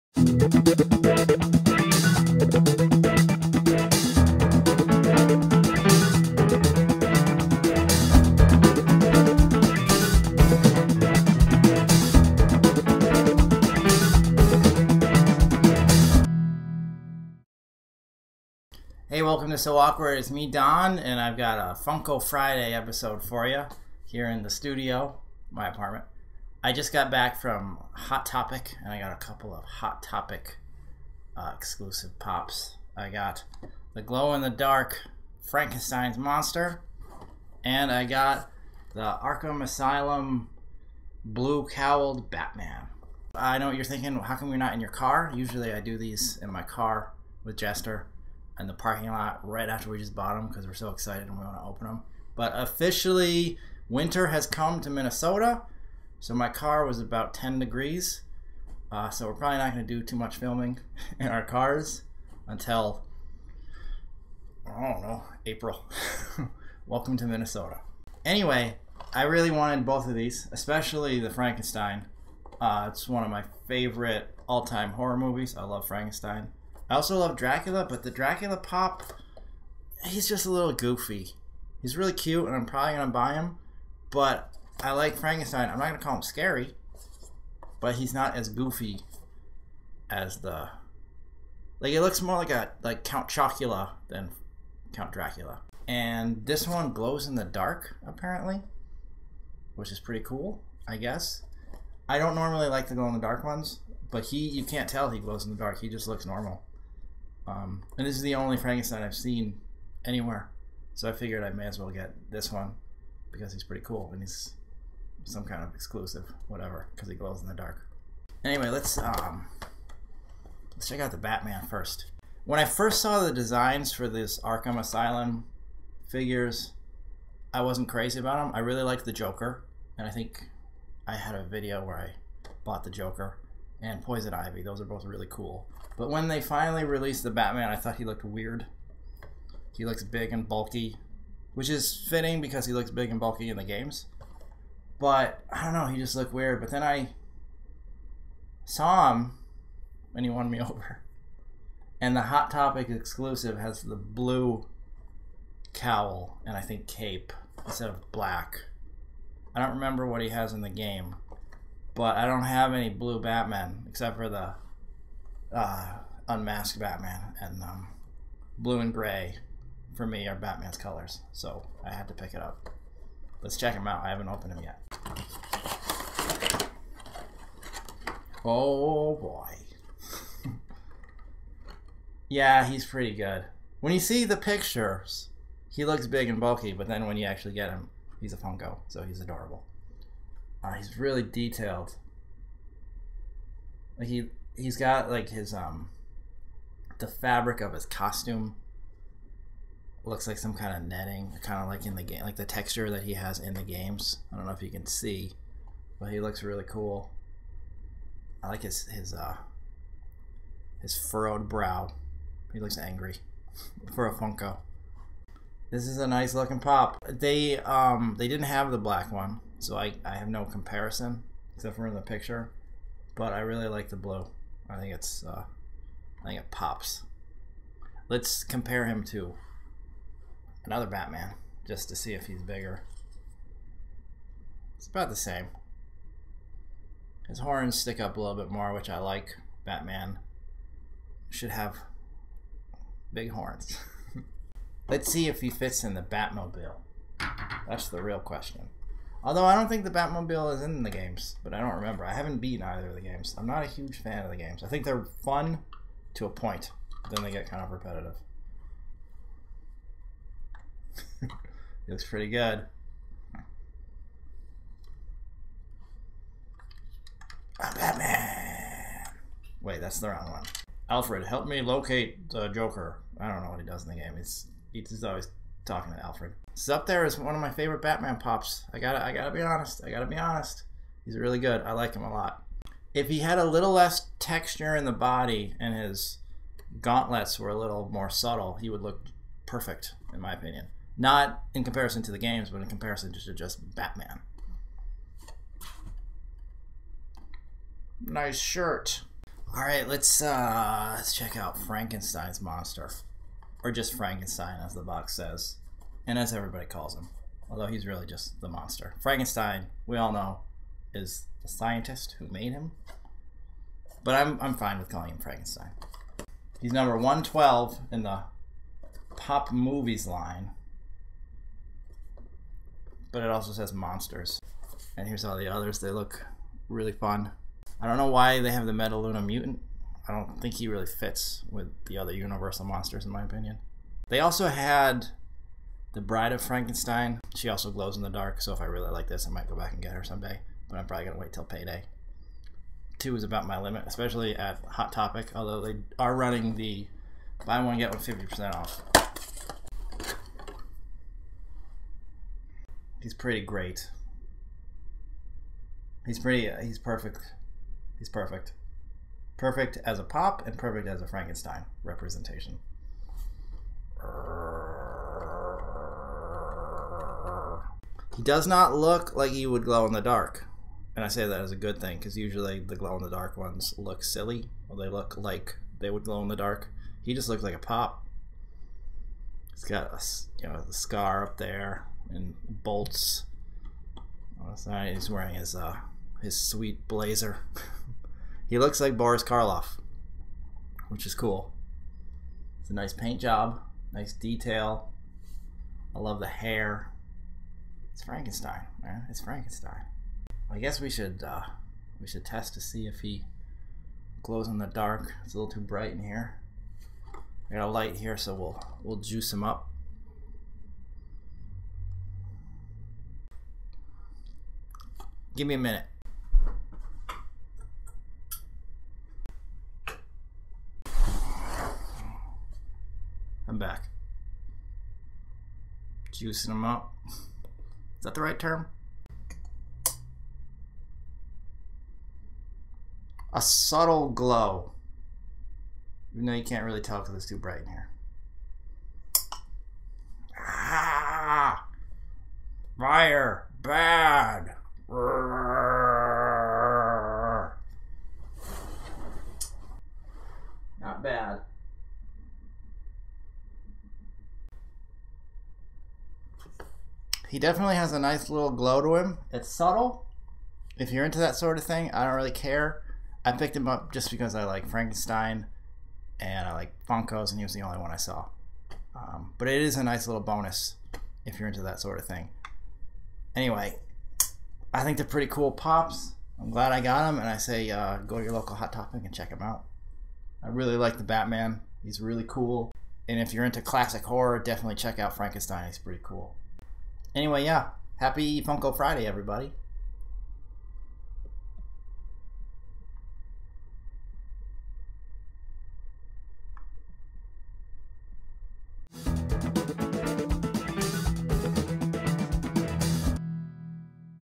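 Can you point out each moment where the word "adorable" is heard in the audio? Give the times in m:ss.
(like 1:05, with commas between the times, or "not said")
3:09.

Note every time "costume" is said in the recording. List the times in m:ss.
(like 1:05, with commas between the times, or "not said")
3:17.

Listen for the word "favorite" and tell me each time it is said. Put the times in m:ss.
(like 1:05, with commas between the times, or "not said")
1:13, 4:37.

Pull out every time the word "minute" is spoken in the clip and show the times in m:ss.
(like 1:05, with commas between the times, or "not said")
6:55.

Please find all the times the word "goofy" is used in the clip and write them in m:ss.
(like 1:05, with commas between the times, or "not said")
1:20, 1:28.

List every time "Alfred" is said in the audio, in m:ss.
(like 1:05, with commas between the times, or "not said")
4:30, 4:35.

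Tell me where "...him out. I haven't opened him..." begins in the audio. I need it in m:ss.
2:53.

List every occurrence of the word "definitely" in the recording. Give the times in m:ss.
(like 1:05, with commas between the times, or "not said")
7:37, 8:04.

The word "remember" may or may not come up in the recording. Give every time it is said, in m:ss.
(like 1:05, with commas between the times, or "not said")
2:39, 4:11.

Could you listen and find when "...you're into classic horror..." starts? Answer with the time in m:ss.
8:03.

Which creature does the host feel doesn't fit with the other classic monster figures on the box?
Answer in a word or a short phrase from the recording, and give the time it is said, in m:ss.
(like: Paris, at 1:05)
Metaluna mutant, at 5:28.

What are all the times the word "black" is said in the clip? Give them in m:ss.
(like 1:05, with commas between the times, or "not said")
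2:38, 3:38.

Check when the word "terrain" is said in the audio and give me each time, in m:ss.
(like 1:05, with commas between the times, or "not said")
not said.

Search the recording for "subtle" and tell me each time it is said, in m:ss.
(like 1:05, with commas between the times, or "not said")
4:48, 7:13, 7:39.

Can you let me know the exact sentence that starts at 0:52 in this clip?
But officially, winter has come to Minnesota.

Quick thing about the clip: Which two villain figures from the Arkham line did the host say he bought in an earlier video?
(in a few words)
Joker and Poison Ivy.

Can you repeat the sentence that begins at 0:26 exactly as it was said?
I just got back from Hot Topic, and I got a couple of Hot Topic uh, exclusive pops.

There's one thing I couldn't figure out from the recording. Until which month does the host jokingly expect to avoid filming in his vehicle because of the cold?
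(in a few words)
April.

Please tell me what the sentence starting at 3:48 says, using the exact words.
Let's compare him to another Batman just to see if he's bigger.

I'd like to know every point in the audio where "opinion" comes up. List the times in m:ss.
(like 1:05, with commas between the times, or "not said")
4:50, 5:33.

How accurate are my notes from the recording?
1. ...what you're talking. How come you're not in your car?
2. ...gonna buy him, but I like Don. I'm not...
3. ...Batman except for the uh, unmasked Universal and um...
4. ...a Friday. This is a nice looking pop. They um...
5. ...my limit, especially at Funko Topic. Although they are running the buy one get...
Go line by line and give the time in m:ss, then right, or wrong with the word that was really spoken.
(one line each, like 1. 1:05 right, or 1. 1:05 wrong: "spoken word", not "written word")
1. 0:43 wrong: "thinking", not "talking"
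2. 1:22 wrong: "Frankenstein", not "Don"
3. 2:43 wrong: "Batman", not "Universal"
4. 3:34 wrong: "Funko", not "Friday"
5. 5:43 wrong: "Hot", not "Funko".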